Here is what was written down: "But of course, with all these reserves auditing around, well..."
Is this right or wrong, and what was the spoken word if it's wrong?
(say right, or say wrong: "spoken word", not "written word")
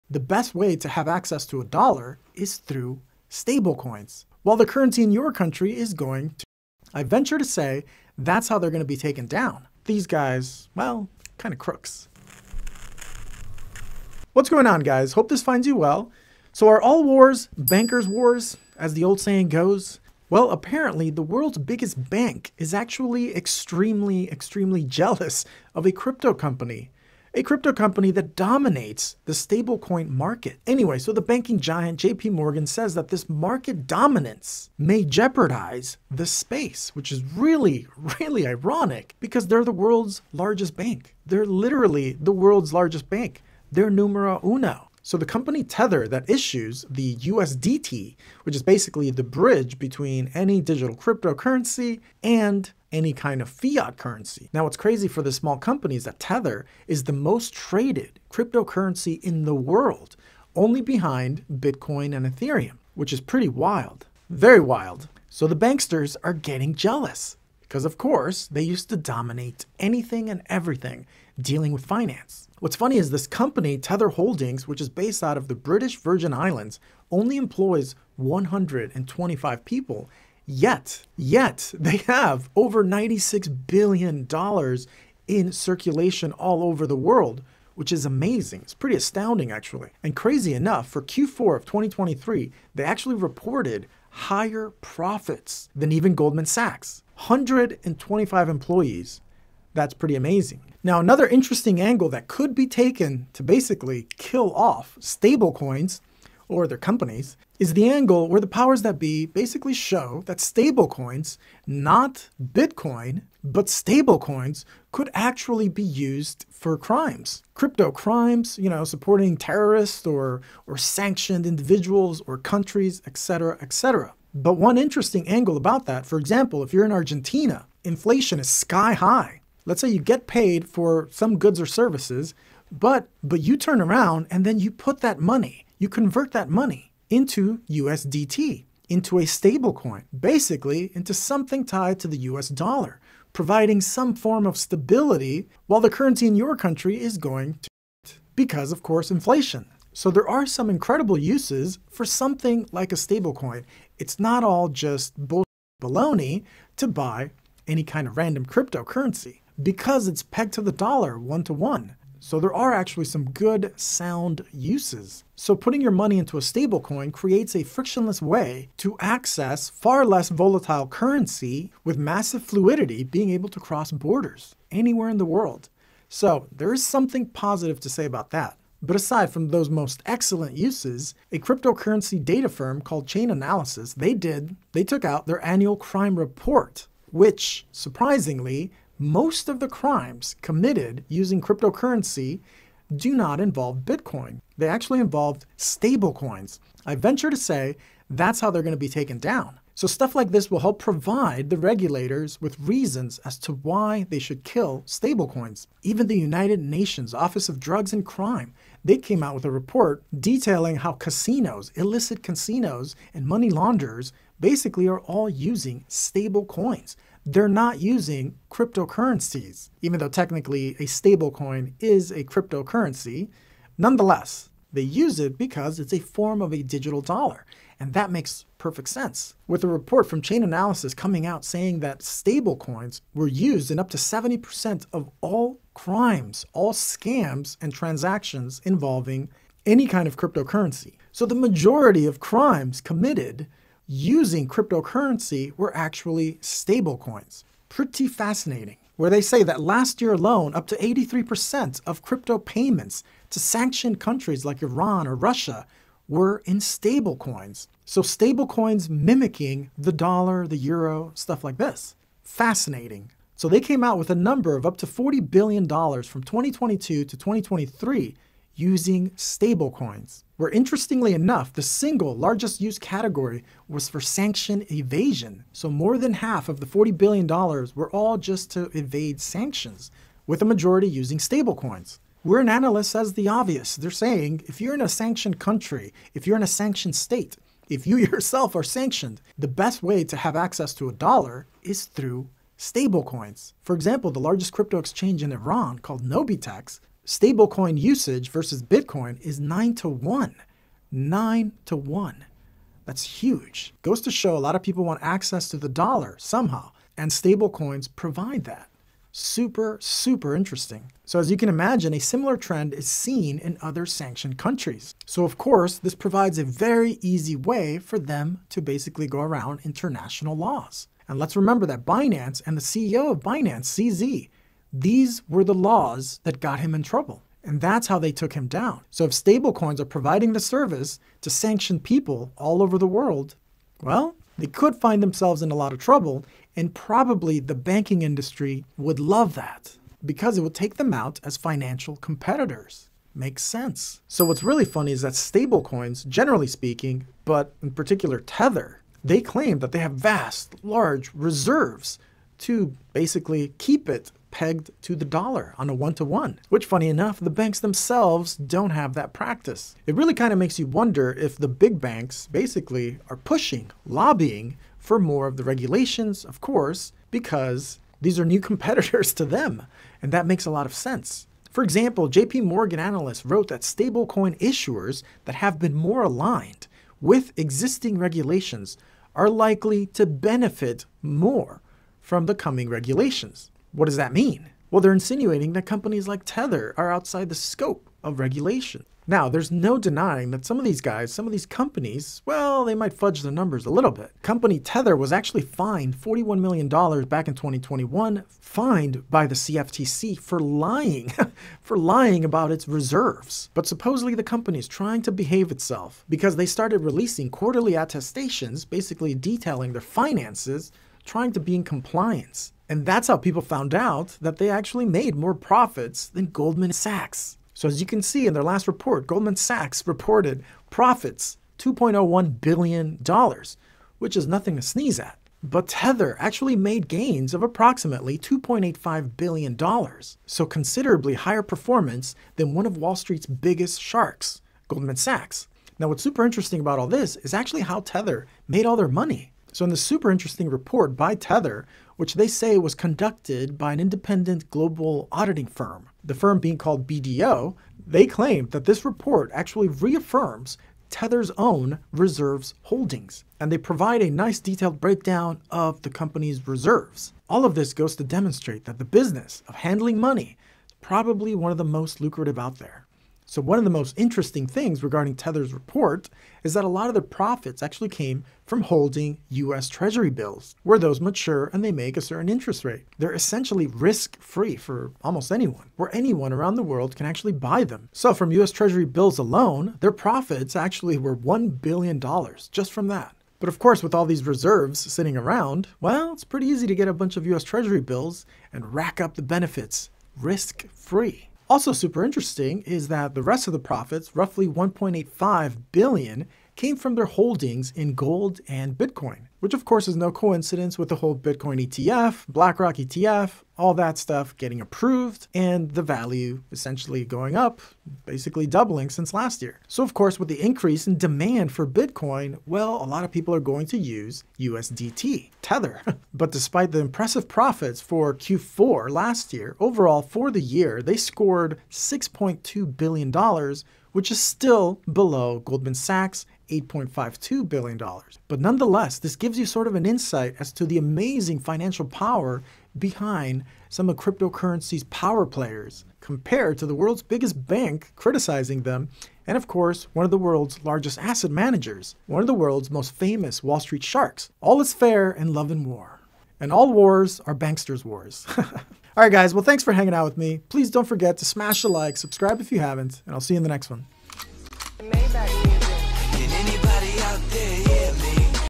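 wrong: "sitting", not "auditing".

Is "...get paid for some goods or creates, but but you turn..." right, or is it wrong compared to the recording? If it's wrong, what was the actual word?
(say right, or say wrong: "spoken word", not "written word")
wrong: "services", not "creates".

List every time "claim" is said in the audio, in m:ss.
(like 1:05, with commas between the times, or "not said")
5:49, 7:28.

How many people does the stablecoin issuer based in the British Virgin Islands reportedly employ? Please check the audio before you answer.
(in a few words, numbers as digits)
125.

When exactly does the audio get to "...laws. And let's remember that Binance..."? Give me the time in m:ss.
5:20.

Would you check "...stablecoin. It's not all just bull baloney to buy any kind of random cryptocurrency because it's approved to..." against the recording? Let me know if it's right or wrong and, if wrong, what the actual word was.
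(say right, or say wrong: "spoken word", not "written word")
wrong: "pegged", not "approved".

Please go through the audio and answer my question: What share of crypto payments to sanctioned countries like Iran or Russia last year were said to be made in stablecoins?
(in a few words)
83%.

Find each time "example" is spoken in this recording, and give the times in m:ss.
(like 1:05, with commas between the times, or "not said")
2:06, 4:53, 6:11.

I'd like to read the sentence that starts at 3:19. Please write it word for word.
So stuff like this will help provide the regulators with reasons as to why they should kill stablecoins.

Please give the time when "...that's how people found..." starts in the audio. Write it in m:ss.
6:52.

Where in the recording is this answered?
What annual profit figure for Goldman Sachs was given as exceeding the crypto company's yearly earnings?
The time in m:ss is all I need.
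8:46.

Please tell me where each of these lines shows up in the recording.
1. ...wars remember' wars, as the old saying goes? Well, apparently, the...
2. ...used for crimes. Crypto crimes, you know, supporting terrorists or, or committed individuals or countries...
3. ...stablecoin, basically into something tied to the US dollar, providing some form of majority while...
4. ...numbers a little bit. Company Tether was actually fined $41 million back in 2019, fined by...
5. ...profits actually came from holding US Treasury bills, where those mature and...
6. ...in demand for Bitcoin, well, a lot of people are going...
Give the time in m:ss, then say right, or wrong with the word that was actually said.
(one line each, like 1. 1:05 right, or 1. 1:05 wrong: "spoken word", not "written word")
1. 0:17 wrong: "bankers", not "remember"
2. 1:55 wrong: "sanctioned", not "committed"
3. 2:19 wrong: "stability", not "majority"
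4. 6:33 wrong: "2021", not "2019"
5. 7:47 right
6. 8:30 right.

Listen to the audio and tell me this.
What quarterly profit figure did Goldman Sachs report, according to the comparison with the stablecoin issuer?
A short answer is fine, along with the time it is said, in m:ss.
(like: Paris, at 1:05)
$2.01 billion, at 7:01.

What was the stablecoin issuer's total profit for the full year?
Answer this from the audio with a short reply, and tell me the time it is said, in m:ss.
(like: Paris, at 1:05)
$6.2 billion, at 8:41.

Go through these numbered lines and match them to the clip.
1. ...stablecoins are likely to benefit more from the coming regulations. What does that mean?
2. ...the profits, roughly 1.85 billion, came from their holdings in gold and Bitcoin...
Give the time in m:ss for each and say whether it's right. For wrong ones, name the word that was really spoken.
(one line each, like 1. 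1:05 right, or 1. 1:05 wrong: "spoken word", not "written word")
1. 6:17 wrong: "regulations", not "stablecoins"
2. 8:13 right.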